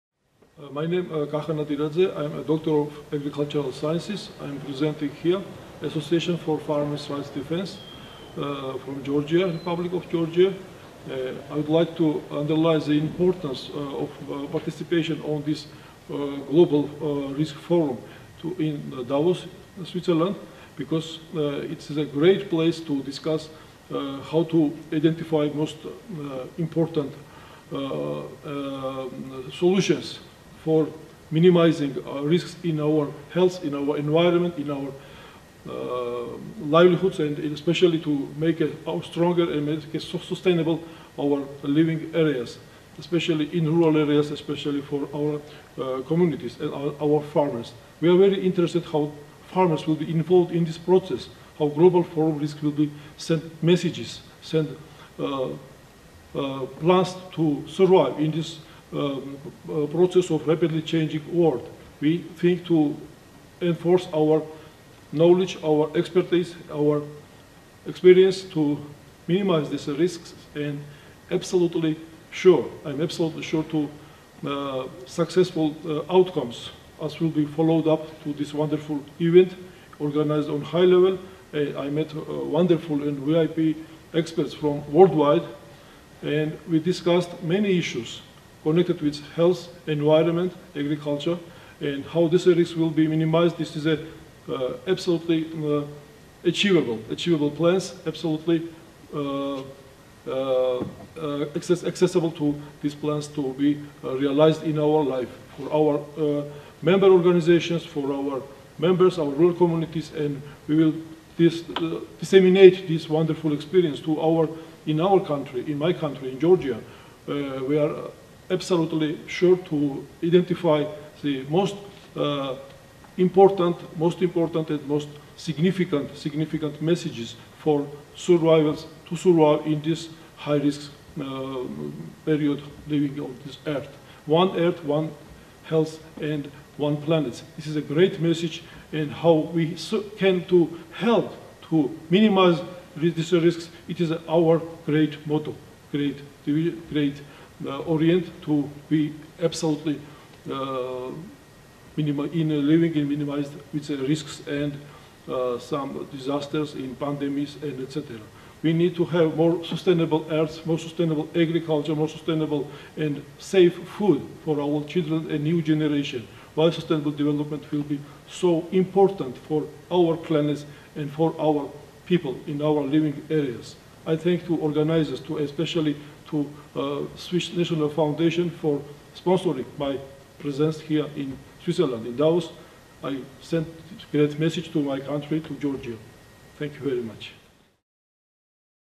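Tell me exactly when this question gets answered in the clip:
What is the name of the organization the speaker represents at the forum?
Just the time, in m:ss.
0:05.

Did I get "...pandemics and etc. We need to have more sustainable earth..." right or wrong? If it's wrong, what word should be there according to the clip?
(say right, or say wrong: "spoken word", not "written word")
right.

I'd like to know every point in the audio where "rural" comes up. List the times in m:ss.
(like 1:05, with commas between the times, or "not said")
0:43, 1:49.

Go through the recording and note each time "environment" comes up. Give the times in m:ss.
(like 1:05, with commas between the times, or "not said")
0:33, 1:29.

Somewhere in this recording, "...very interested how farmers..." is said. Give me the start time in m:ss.
0:48.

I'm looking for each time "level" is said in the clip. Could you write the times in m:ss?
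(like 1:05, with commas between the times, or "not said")
1:20.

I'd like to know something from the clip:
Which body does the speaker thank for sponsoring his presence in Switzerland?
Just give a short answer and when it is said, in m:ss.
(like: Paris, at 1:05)
Swiss National Foundation, at 2:57.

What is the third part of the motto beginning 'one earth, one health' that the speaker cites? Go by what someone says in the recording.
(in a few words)
One planet.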